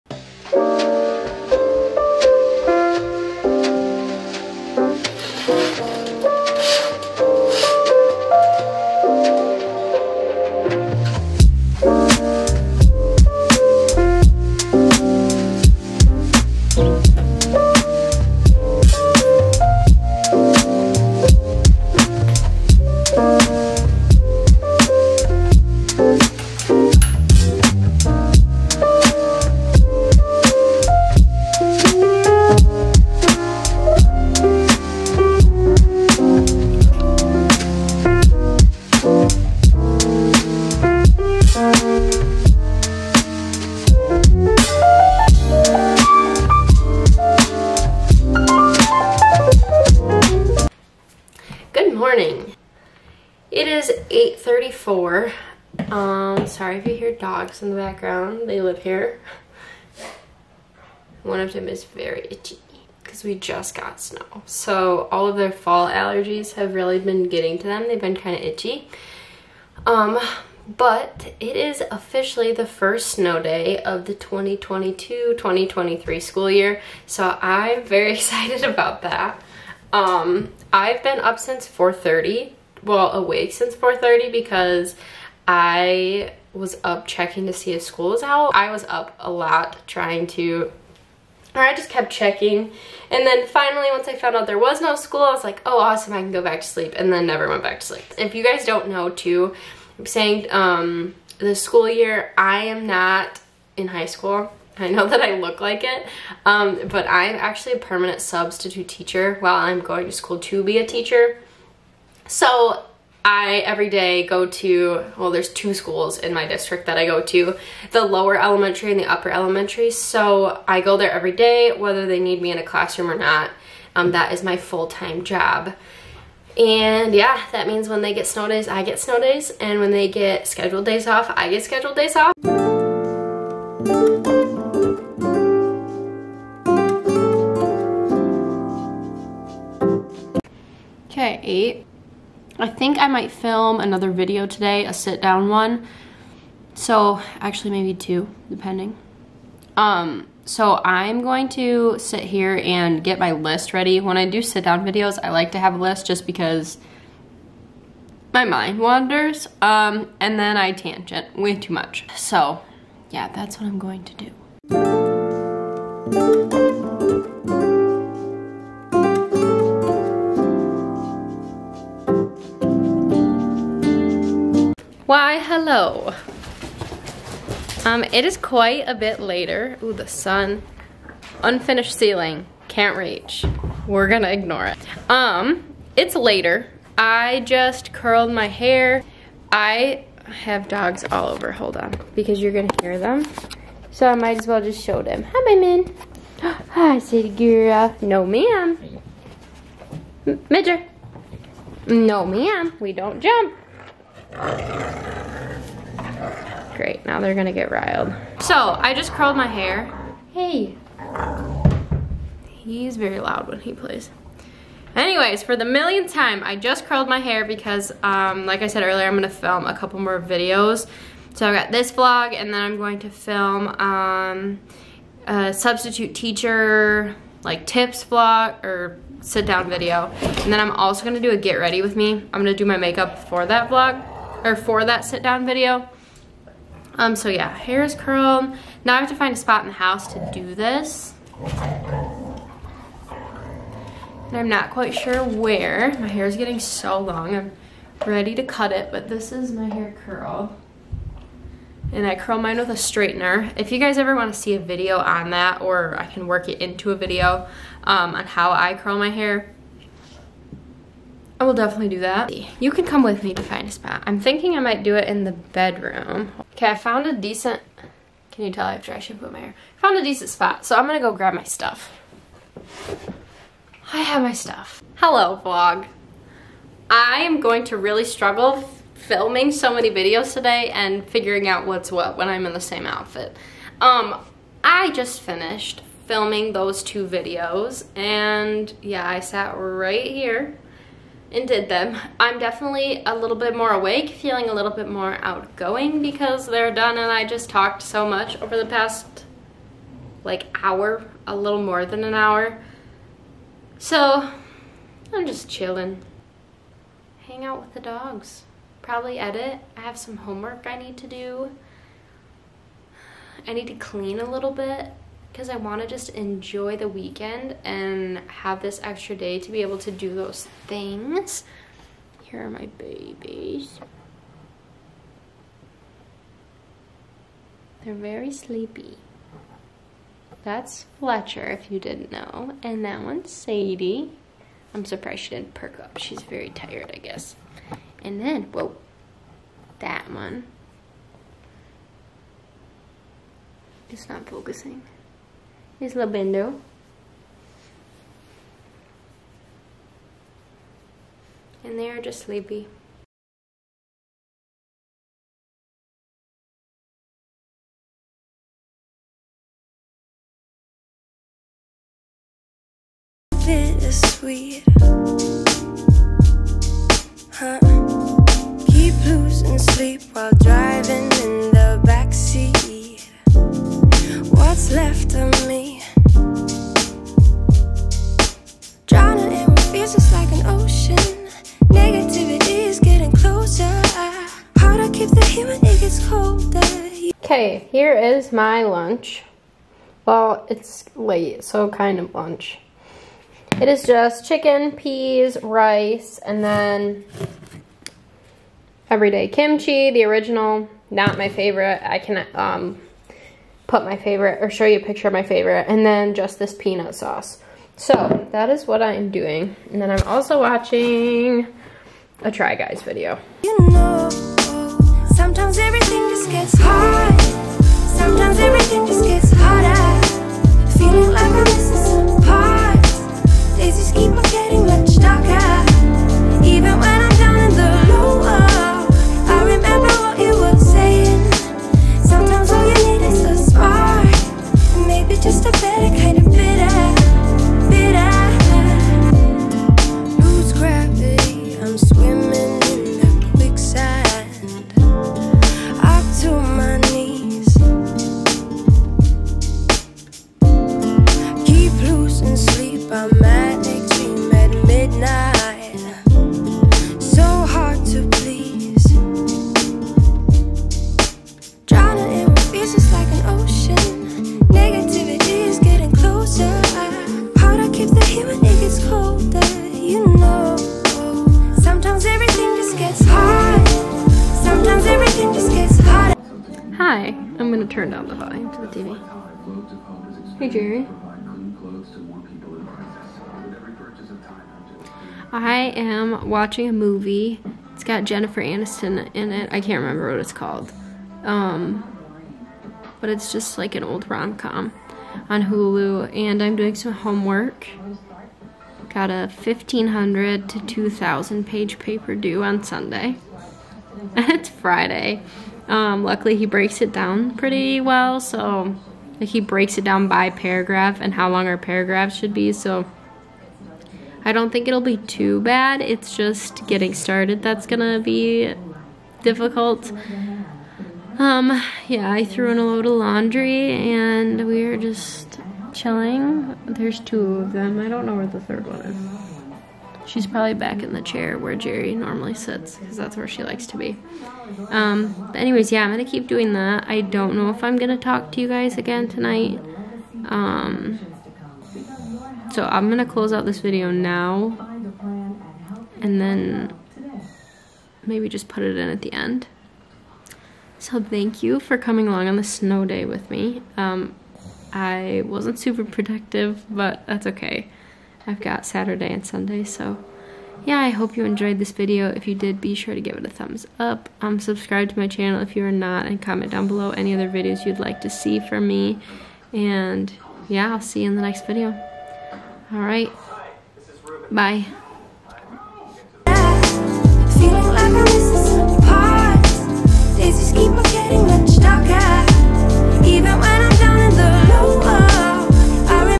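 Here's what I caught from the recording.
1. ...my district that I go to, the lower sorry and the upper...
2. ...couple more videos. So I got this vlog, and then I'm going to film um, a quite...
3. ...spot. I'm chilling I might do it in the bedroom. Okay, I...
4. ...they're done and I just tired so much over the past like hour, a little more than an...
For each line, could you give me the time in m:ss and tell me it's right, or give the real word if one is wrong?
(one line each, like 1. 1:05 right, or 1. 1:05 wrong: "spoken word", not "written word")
1. 1:56 wrong: "elementary", not "sorry"
2. 3:39 wrong: "substitute", not "quite"
3. 4:23 wrong: "thinking", not "chilling"
4. 4:56 wrong: "talked", not "tired".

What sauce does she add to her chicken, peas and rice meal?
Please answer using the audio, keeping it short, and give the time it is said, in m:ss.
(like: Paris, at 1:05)
peanut sauce, at 6:46.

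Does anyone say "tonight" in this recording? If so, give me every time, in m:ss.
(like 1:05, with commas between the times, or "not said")
8:59.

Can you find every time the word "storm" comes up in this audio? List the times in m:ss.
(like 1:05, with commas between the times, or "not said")
not said.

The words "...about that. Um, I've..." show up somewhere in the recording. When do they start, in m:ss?
1:18.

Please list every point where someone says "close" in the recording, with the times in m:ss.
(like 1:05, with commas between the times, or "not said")
9:03.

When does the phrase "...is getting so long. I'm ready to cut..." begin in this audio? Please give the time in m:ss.
4:06.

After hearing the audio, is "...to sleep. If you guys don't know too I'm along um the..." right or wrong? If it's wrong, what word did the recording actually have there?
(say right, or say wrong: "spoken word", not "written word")
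wrong: "saying", not "along".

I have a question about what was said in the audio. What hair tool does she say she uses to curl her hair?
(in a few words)
straightener.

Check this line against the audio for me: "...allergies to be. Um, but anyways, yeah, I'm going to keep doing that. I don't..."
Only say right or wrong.
wrong.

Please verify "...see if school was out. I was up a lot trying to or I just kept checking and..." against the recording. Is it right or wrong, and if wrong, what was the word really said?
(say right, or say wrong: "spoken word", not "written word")
right.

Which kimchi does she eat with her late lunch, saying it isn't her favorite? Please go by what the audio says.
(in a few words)
Everyday kimchi, the original.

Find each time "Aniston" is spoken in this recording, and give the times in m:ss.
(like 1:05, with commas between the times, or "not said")
8:08.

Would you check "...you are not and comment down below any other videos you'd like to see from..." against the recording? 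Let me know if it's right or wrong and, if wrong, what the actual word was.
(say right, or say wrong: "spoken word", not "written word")
right.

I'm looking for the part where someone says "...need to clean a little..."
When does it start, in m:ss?
5:13.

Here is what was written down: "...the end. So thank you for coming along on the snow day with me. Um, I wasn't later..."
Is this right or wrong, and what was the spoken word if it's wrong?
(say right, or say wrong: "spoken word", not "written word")
wrong: "super", not "later".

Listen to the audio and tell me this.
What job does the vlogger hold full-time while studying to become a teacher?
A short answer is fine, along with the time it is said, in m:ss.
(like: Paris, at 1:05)
permanent substitute teacher, at 1:47.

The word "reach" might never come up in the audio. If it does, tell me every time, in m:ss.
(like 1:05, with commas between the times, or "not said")
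3:02.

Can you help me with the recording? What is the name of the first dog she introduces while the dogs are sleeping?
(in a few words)
Fletcher.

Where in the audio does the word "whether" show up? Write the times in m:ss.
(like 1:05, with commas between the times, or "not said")
2:01.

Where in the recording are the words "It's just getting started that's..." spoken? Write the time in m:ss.
8:35.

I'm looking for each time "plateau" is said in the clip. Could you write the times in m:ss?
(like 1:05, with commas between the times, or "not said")
not said.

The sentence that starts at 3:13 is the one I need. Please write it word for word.
So I might as well just show them.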